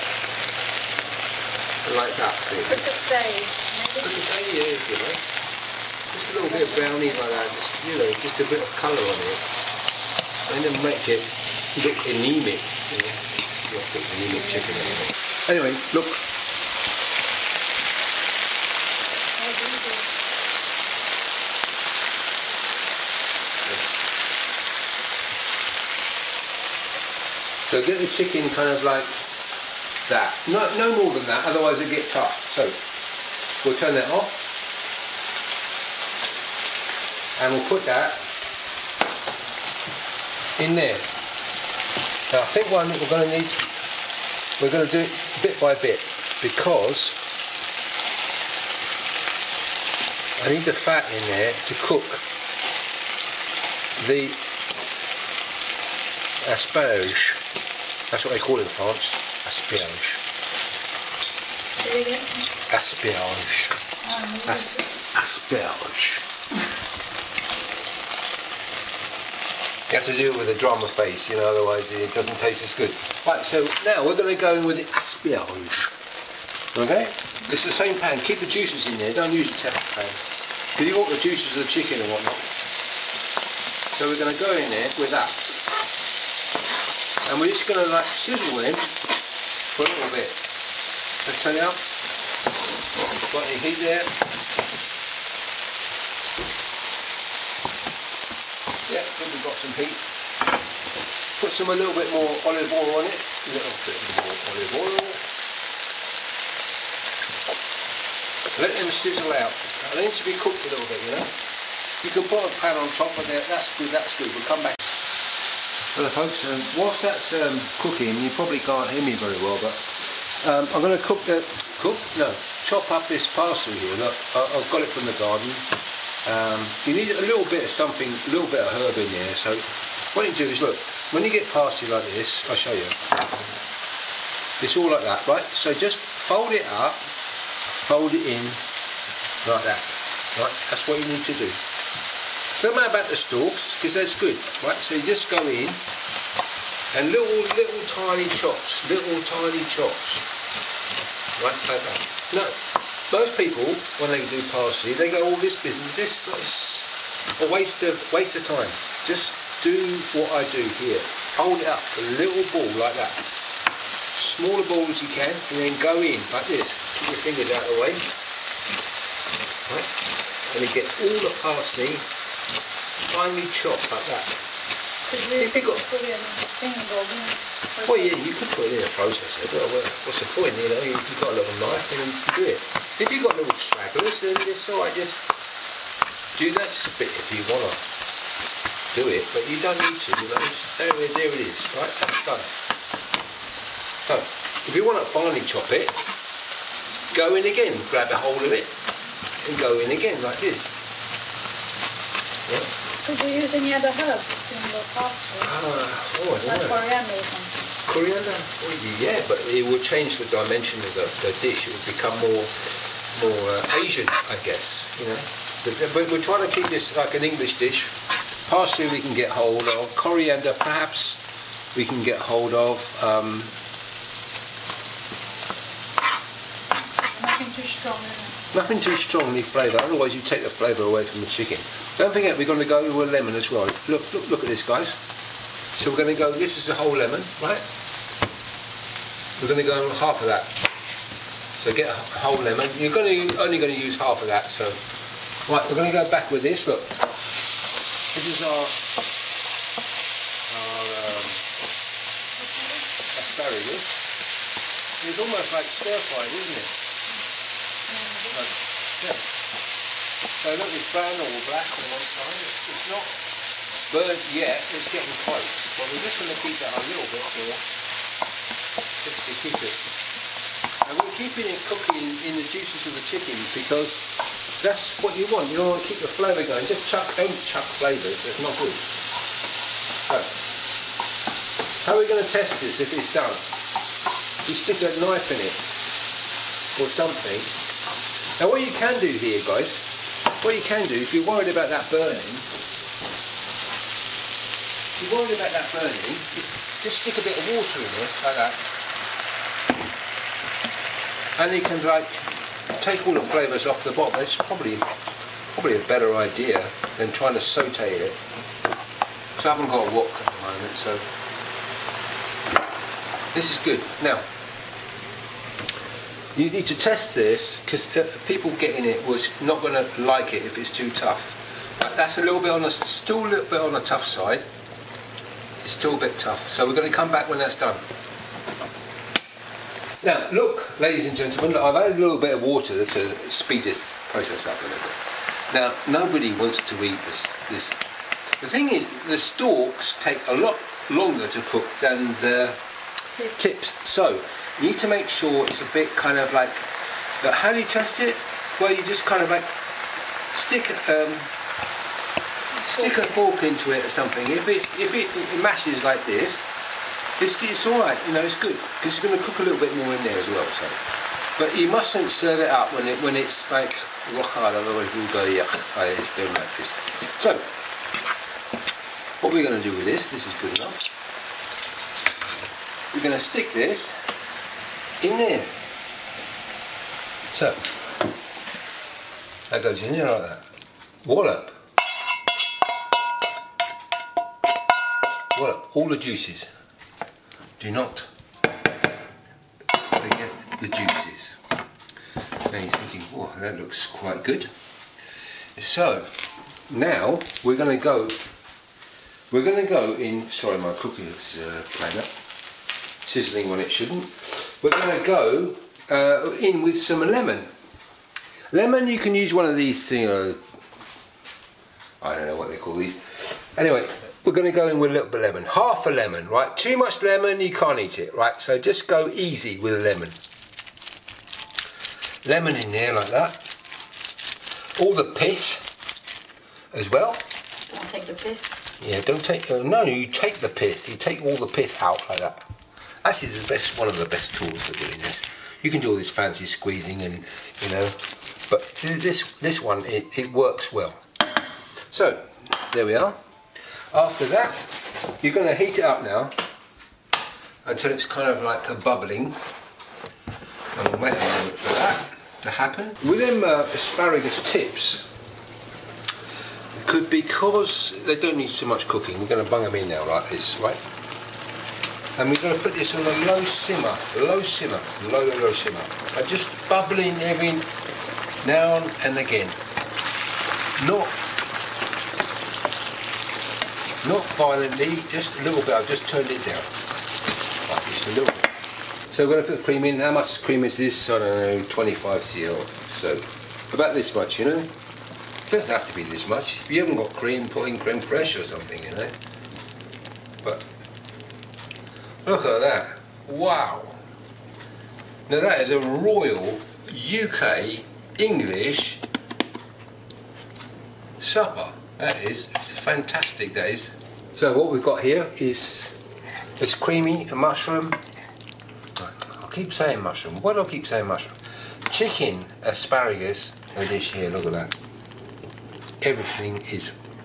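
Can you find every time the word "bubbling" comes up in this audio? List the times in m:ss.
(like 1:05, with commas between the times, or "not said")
7:28, 7:46.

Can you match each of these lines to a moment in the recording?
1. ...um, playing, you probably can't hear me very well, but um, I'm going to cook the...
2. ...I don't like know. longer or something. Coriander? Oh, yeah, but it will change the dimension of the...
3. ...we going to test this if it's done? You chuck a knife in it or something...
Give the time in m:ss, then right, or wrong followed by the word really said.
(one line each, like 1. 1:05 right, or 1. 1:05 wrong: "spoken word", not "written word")
1. 1:57 wrong: "cooking", not "playing"
2. 3:25 wrong: "coriander", not "longer"
3. 4:42 wrong: "stick", not "chuck".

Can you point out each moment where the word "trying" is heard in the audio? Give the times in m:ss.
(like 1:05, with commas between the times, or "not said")
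3:36, 5:07.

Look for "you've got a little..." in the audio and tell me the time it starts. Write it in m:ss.
3:00.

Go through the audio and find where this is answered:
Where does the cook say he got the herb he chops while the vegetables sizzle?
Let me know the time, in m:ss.
2:04.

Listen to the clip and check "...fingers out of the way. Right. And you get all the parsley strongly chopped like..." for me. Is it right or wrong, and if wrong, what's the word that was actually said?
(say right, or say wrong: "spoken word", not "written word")
wrong: "finely", not "strongly".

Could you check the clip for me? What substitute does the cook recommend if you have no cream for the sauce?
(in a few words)
creme fraiche.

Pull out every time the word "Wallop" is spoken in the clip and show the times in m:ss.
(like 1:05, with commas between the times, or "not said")
6:21, 6:25.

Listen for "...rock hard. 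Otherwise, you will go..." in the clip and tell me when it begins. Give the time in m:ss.
6:04.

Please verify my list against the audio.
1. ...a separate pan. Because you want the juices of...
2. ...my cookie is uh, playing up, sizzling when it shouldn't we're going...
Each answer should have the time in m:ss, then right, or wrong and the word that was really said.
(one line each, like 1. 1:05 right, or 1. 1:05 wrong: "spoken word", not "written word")
1. 1:19 right
2. 6:40 right.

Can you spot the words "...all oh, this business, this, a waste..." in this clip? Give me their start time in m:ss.
2:35.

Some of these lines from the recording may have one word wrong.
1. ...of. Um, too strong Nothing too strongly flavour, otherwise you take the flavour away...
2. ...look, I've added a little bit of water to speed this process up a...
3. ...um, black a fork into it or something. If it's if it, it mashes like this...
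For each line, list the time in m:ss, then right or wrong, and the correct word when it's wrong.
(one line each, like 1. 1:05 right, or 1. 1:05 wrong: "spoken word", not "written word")
1. 3:42 right
2. 5:31 right
3. 5:50 wrong: "stick", not "black".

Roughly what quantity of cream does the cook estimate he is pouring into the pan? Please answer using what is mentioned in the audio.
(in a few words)
25 cl.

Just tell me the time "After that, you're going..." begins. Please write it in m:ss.
7:23.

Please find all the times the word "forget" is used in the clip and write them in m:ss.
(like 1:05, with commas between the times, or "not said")
3:52, 6:29.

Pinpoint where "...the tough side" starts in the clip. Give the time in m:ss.
5:23.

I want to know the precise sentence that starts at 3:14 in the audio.
So, if you want to finely chop it, go in again, grab a hold of it, and go in again, like this.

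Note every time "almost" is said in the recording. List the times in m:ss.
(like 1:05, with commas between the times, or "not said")
4:15.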